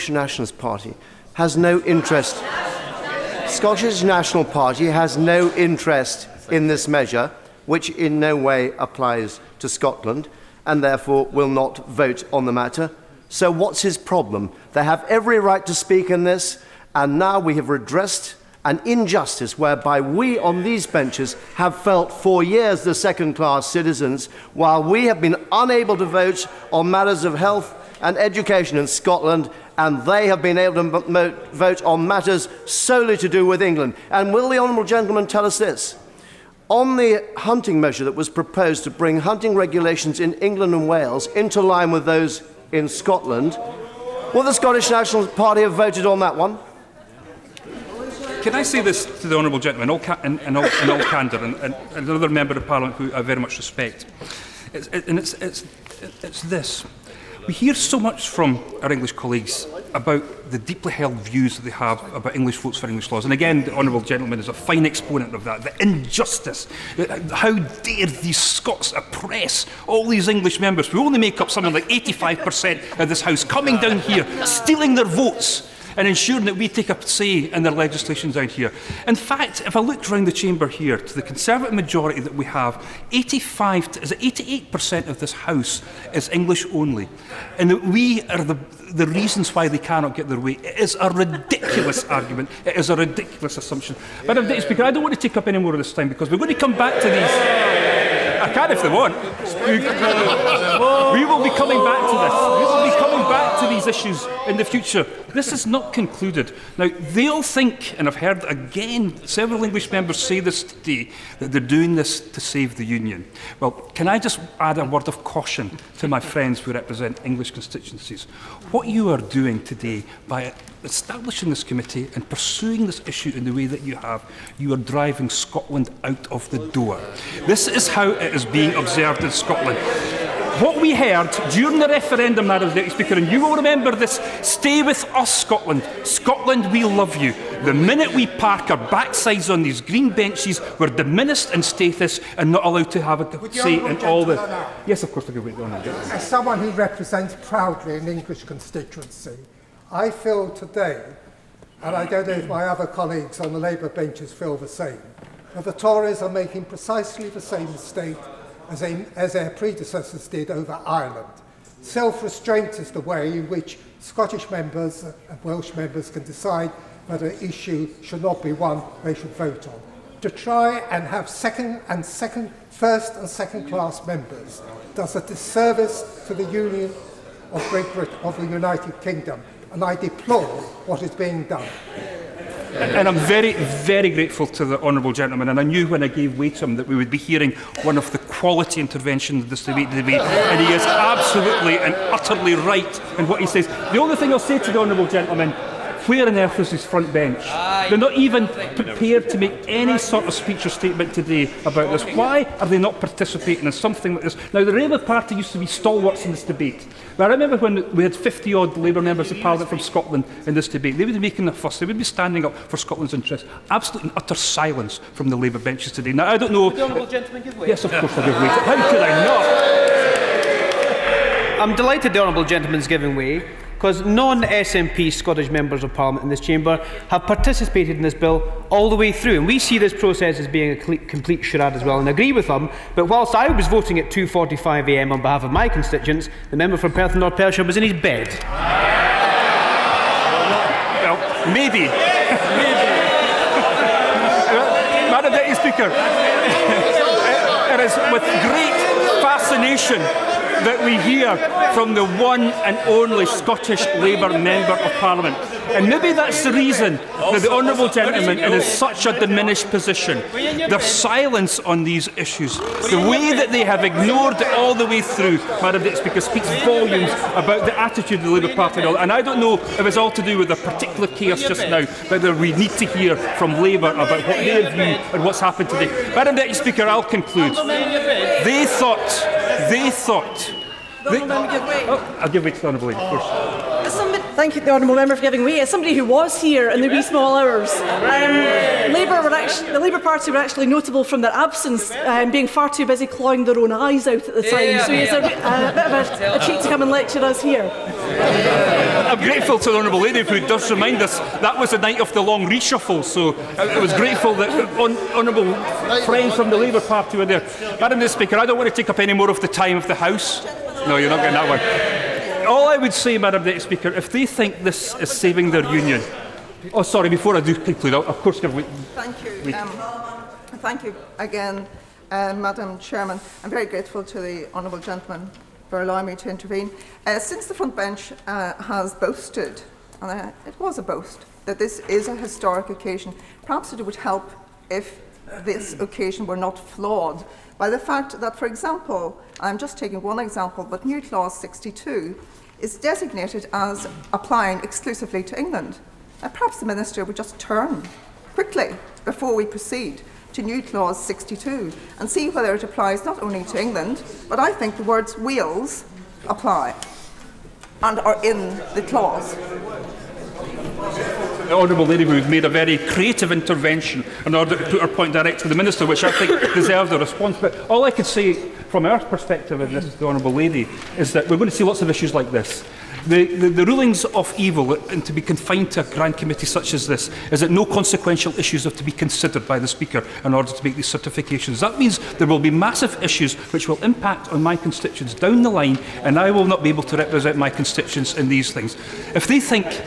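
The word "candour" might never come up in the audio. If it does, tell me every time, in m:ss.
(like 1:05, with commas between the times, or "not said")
0:51.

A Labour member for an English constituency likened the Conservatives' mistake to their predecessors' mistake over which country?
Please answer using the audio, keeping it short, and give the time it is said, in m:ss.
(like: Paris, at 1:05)
Ireland, at 2:40.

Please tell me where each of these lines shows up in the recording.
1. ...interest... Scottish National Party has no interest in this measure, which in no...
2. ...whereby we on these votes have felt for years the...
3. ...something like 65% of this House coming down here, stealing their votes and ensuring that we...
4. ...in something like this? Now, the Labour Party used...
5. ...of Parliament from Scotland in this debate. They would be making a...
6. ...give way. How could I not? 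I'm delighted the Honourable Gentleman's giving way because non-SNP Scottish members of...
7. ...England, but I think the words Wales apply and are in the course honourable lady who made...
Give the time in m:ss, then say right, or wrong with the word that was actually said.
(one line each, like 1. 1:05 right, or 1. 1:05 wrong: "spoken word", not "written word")
1. 0:01 right
2. 0:19 wrong: "benches", not "votes"
3. 1:11 wrong: "85", not "65"
4. 3:23 right
5. 3:29 right
6. 3:38 right
7. 5:53 wrong: "clause", not "course".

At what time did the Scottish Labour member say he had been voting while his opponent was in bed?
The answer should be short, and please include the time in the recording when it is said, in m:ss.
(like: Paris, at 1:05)
2.45am, at 3:54.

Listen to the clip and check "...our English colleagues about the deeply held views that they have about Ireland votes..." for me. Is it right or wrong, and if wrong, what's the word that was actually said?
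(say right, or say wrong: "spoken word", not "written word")
wrong: "English", not "Ireland".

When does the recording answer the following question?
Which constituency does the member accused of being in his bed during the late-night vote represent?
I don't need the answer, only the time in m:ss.
3:56.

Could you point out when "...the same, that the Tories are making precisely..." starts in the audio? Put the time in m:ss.
2:34.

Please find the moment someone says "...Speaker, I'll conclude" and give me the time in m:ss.
4:36.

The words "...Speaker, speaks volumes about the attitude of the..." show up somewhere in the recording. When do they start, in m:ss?
4:26.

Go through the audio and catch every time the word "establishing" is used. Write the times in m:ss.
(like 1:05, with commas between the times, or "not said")
2:00.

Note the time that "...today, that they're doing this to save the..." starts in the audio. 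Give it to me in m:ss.
1:50.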